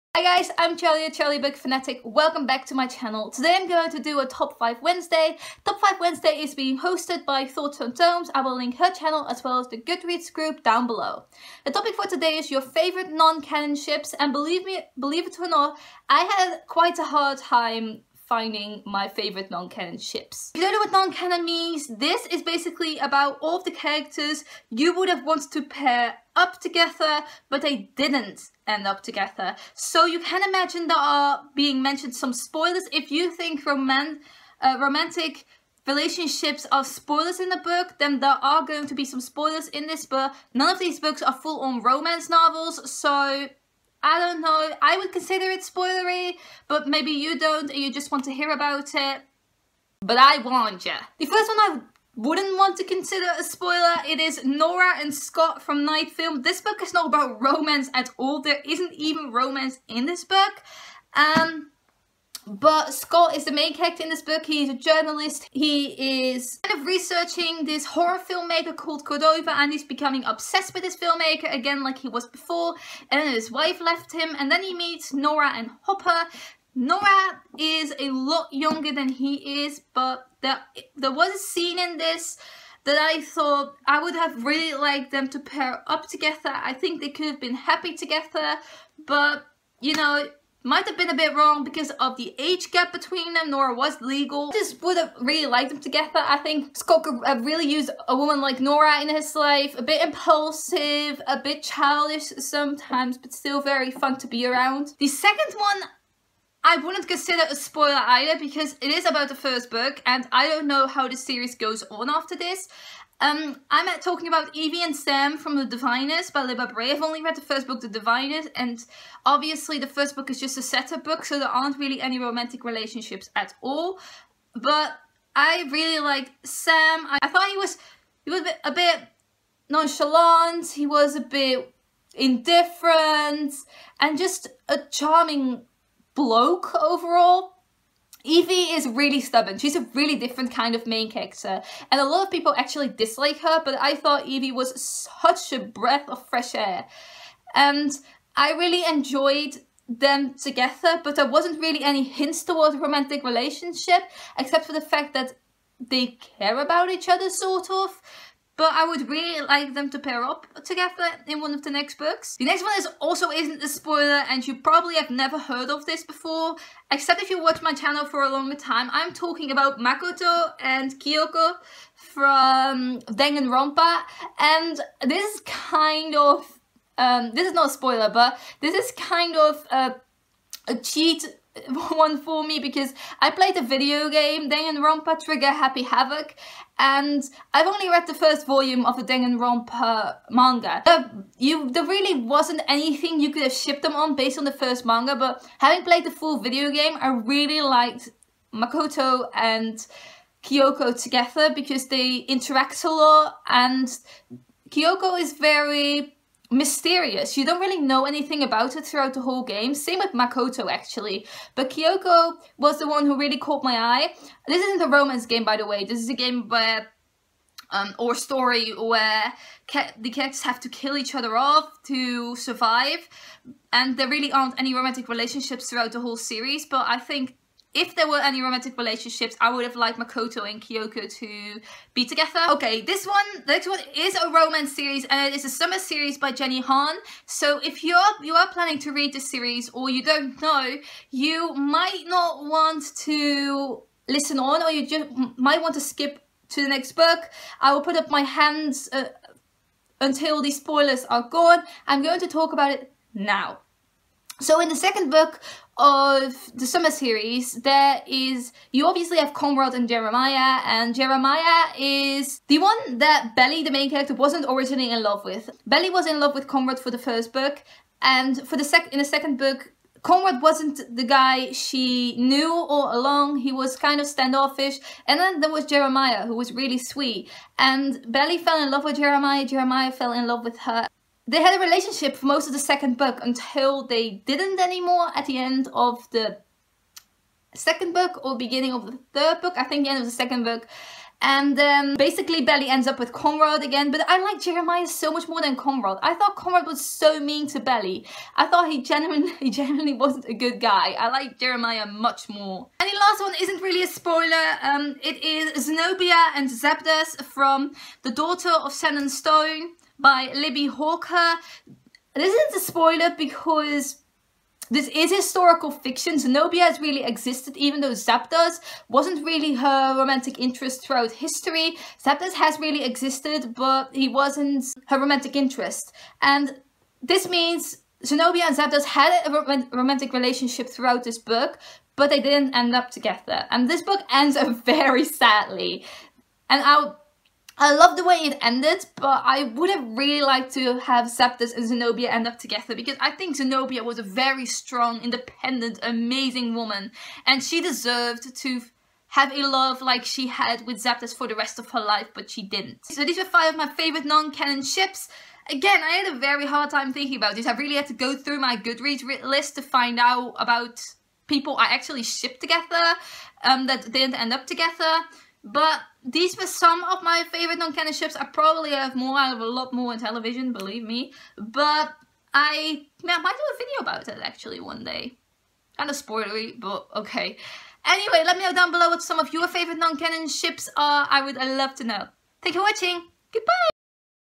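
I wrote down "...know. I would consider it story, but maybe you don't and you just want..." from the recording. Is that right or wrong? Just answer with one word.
wrong.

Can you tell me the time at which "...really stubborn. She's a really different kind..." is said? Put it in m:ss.
2:18.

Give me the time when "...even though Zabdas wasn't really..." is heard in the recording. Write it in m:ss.
5:17.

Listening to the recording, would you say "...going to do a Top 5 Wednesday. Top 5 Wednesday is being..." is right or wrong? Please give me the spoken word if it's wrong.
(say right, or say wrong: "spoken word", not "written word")
right.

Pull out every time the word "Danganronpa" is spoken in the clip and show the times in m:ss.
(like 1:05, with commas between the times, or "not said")
2:53, 3:04, 3:09.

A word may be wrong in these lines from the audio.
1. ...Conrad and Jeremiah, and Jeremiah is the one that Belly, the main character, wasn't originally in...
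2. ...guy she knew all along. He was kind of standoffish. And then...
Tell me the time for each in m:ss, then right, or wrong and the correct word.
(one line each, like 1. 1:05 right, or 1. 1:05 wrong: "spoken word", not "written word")
1. 4:19 right
2. 4:31 right.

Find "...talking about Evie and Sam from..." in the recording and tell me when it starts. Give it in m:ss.
1:53.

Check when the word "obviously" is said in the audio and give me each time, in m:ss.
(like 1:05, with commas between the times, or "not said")
1:59, 4:18.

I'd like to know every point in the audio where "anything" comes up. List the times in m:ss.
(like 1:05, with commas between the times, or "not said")
3:12, 3:28.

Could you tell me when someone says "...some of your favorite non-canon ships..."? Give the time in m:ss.
6:19.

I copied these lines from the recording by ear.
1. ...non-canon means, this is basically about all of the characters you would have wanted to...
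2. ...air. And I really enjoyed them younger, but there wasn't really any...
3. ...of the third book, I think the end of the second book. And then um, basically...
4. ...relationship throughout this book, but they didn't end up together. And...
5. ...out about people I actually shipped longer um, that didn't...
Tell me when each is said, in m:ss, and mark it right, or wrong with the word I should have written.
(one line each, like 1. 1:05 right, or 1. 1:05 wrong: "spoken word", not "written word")
1. 0:20 right
2. 2:26 wrong: "together", not "younger"
3. 4:48 right
4. 5:30 right
5. 5:59 wrong: "together", not "longer".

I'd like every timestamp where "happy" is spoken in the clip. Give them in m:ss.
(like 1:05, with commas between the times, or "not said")
1:27, 3:05.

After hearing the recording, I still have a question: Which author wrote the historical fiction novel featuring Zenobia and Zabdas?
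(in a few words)
Libbie Hawker.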